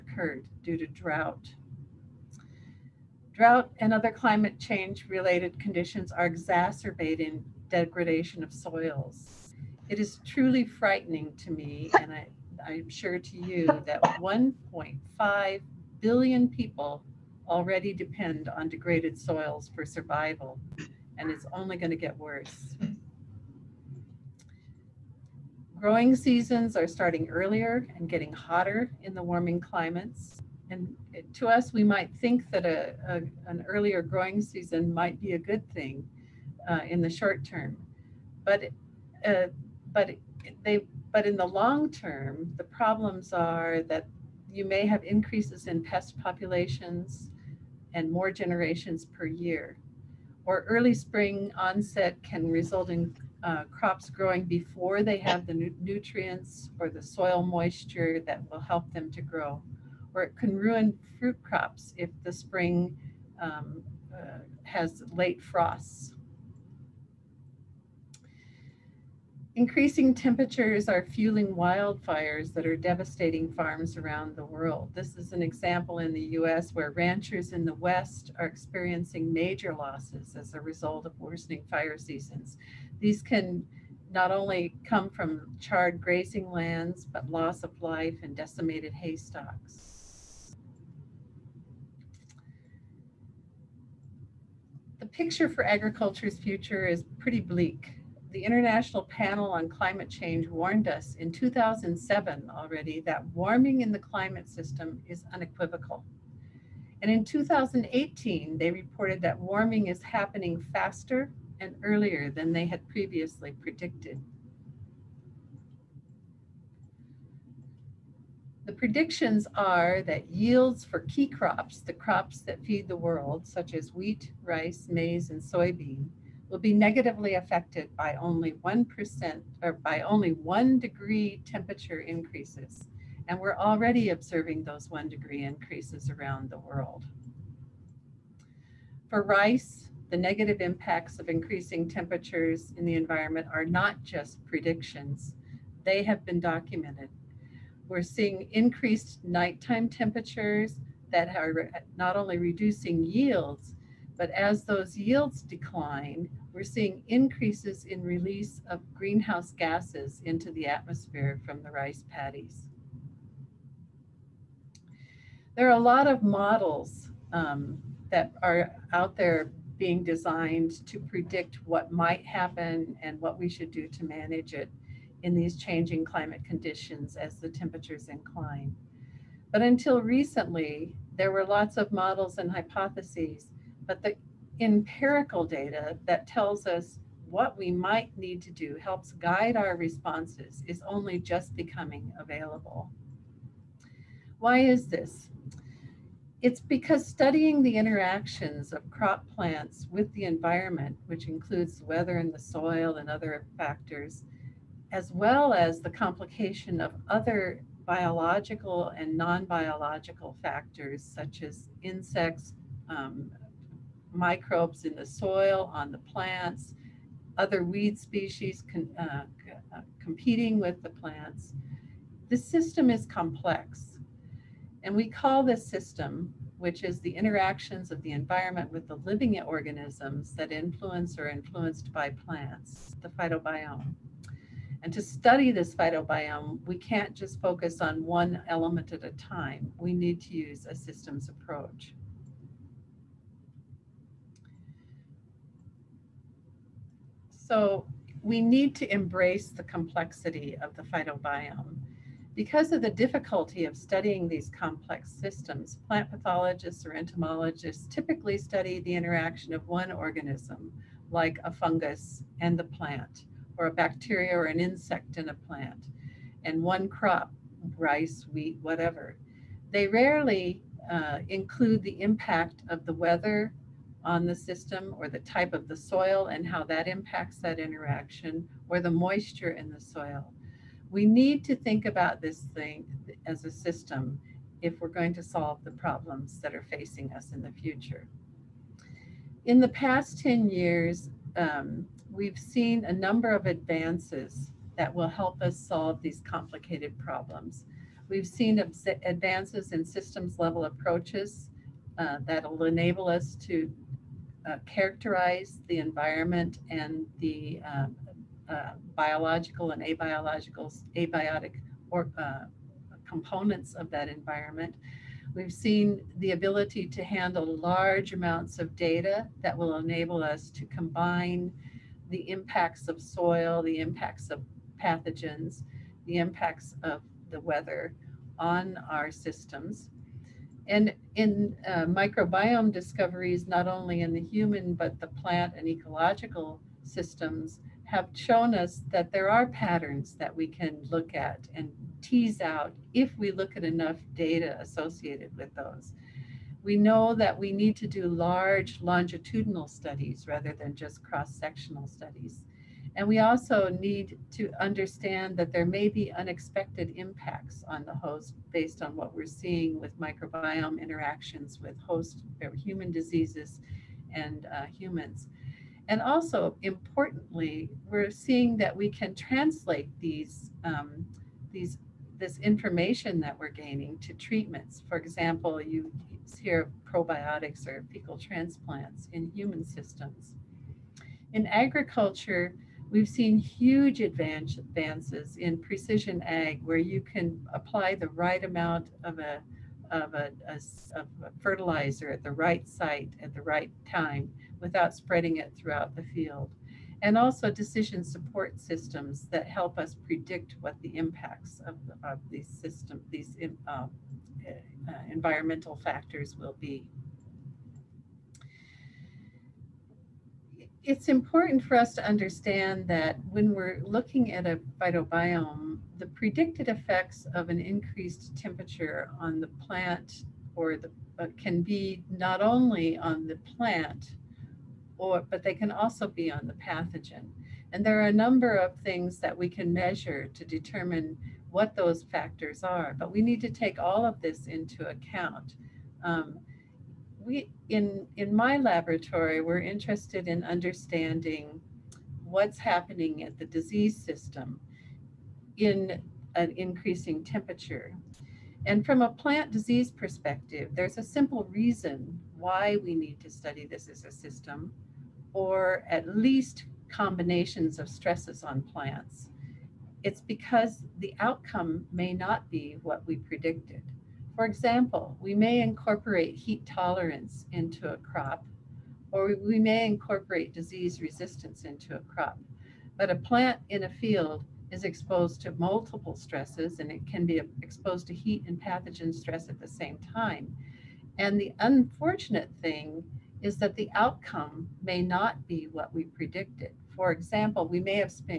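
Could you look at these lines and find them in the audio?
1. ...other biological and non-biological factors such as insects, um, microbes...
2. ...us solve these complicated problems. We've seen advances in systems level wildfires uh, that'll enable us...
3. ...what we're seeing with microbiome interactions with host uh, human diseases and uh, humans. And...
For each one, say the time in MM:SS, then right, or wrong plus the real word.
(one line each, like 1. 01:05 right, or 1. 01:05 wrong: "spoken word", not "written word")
1. 03:27 right
2. 04:55 wrong: "approaches", not "wildfires"
3. 05:58 right.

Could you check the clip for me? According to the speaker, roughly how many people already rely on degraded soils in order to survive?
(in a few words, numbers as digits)
1.5 billion.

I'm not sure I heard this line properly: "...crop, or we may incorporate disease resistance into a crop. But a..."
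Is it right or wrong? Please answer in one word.
right.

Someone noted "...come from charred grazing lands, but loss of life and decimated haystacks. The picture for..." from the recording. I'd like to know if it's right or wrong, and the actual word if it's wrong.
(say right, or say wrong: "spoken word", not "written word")
right.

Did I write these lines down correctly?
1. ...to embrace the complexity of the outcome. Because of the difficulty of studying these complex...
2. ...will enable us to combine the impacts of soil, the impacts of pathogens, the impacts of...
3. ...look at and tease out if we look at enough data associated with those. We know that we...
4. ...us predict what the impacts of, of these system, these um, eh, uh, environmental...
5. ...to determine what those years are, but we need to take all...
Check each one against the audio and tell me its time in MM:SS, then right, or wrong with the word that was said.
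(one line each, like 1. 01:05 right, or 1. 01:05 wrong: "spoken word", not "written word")
1. 04:08 wrong: "phytobiome", not "outcome"
2. 05:19 right
3. 05:40 right
4. 06:39 right
5. 07:10 wrong: "factors", not "years".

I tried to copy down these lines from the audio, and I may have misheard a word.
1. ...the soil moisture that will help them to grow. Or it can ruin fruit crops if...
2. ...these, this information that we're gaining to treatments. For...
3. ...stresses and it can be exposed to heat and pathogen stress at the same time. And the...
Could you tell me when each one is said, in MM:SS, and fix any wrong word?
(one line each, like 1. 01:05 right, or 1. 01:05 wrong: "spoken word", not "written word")
1. 00:56 right
2. 06:11 right
3. 07:56 right.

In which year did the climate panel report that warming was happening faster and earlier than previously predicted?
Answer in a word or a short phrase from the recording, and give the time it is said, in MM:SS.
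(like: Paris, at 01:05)
2018, at 01:47.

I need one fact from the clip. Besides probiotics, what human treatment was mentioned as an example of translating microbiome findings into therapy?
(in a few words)
Fecal transplants.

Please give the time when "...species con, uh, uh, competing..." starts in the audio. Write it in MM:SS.
03:37.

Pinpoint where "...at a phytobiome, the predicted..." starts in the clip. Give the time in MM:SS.
06:54.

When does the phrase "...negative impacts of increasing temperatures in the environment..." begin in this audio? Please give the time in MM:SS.
02:20.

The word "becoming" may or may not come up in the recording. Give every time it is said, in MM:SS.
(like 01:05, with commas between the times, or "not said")
03:11.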